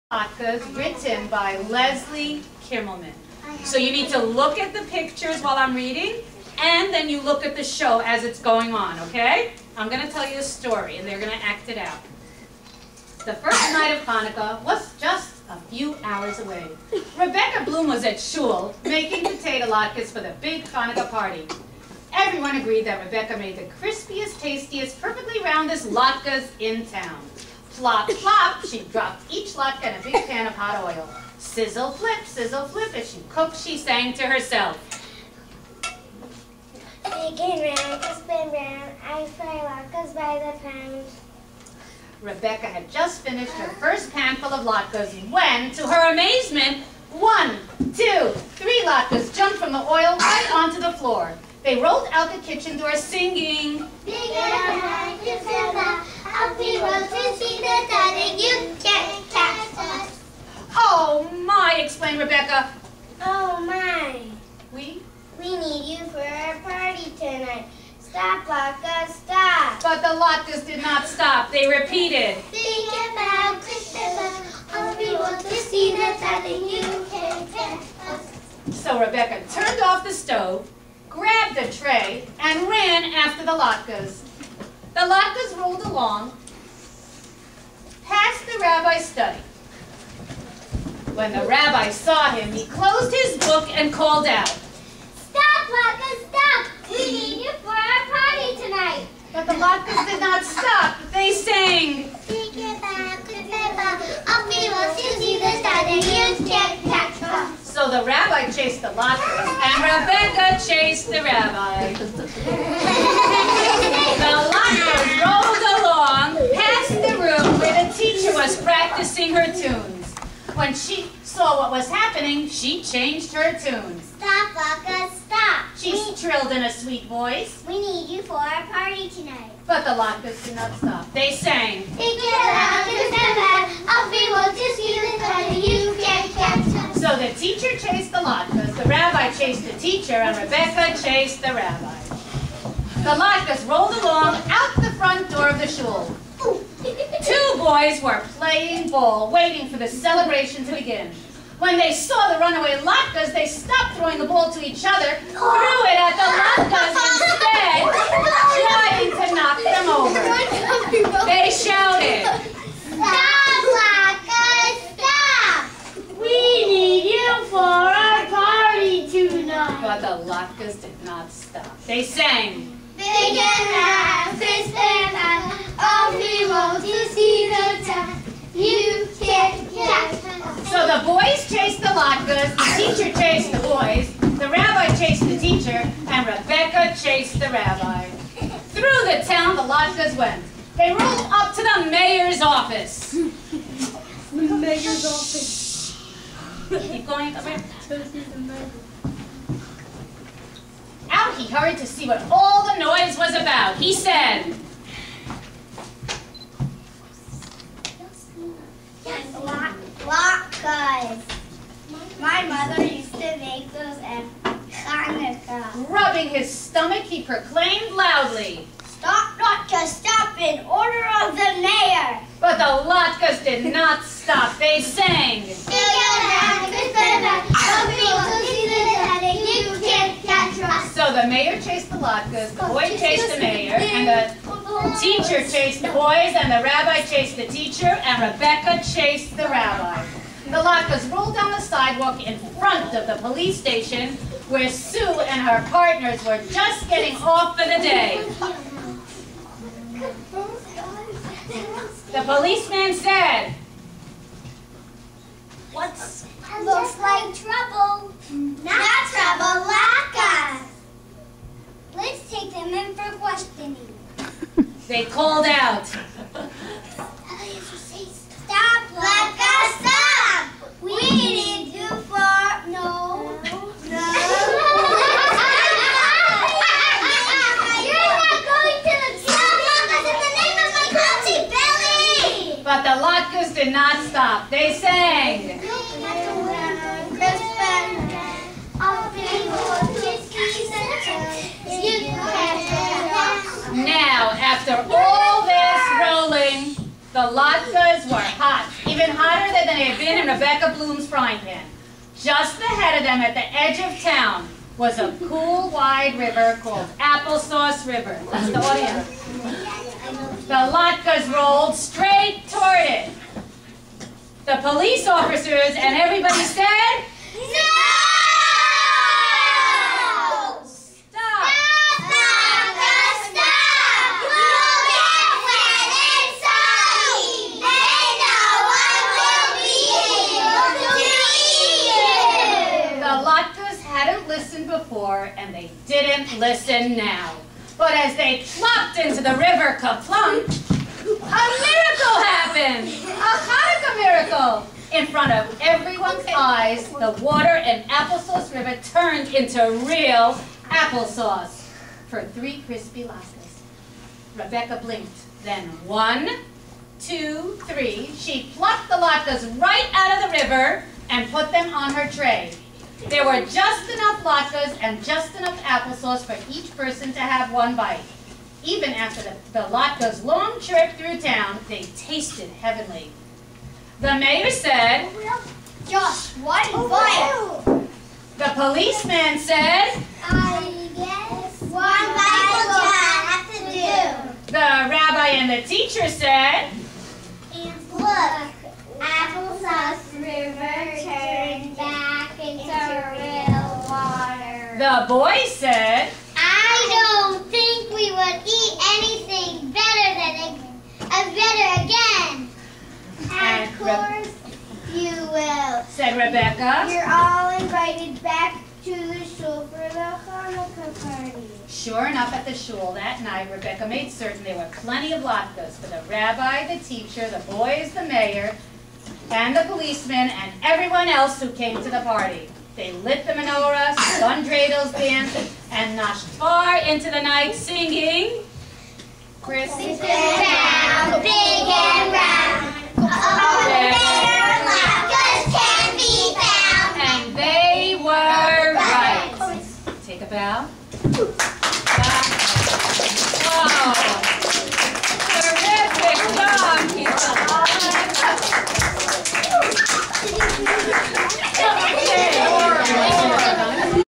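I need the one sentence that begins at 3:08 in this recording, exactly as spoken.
Through the town the lot went.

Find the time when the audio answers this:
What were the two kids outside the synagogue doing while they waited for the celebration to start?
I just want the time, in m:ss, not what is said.
2:28.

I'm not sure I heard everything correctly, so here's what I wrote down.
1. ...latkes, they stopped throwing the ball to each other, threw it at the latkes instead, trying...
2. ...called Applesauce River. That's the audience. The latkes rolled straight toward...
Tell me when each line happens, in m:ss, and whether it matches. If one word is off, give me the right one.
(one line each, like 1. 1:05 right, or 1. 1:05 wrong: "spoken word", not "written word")
1. 2:32 right
2. 5:06 right.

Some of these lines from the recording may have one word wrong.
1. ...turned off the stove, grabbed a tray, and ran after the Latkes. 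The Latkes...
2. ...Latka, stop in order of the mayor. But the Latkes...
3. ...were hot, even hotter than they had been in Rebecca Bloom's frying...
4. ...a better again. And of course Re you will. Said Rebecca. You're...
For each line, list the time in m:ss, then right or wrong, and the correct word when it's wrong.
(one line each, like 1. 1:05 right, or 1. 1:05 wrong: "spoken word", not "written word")
1. 1:19 right
2. 3:39 right
3. 4:58 right
4. 6:41 right.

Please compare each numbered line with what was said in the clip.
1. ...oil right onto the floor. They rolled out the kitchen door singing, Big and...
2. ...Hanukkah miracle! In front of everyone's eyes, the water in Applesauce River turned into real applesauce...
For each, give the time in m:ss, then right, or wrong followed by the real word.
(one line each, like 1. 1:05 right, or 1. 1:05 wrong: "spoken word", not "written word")
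1. 0:49 right
2. 5:43 right.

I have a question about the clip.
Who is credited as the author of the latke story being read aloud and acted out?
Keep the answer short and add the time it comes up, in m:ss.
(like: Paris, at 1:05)
Leslie Kimmelman, at 0:01.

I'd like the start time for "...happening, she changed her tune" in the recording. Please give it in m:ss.
2:01.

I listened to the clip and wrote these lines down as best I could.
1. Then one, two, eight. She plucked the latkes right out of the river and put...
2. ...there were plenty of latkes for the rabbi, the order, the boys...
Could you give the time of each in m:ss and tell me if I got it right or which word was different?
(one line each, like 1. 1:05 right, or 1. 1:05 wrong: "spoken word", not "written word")
1. 5:55 wrong: "three", not "eight"
2. 6:54 wrong: "teacher", not "order".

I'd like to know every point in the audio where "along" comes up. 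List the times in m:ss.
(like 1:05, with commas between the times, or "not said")
1:25, 2:23.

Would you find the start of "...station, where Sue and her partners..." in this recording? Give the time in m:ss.
4:03.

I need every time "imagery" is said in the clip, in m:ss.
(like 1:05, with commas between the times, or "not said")
not said.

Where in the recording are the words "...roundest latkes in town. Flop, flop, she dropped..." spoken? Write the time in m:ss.
0:25.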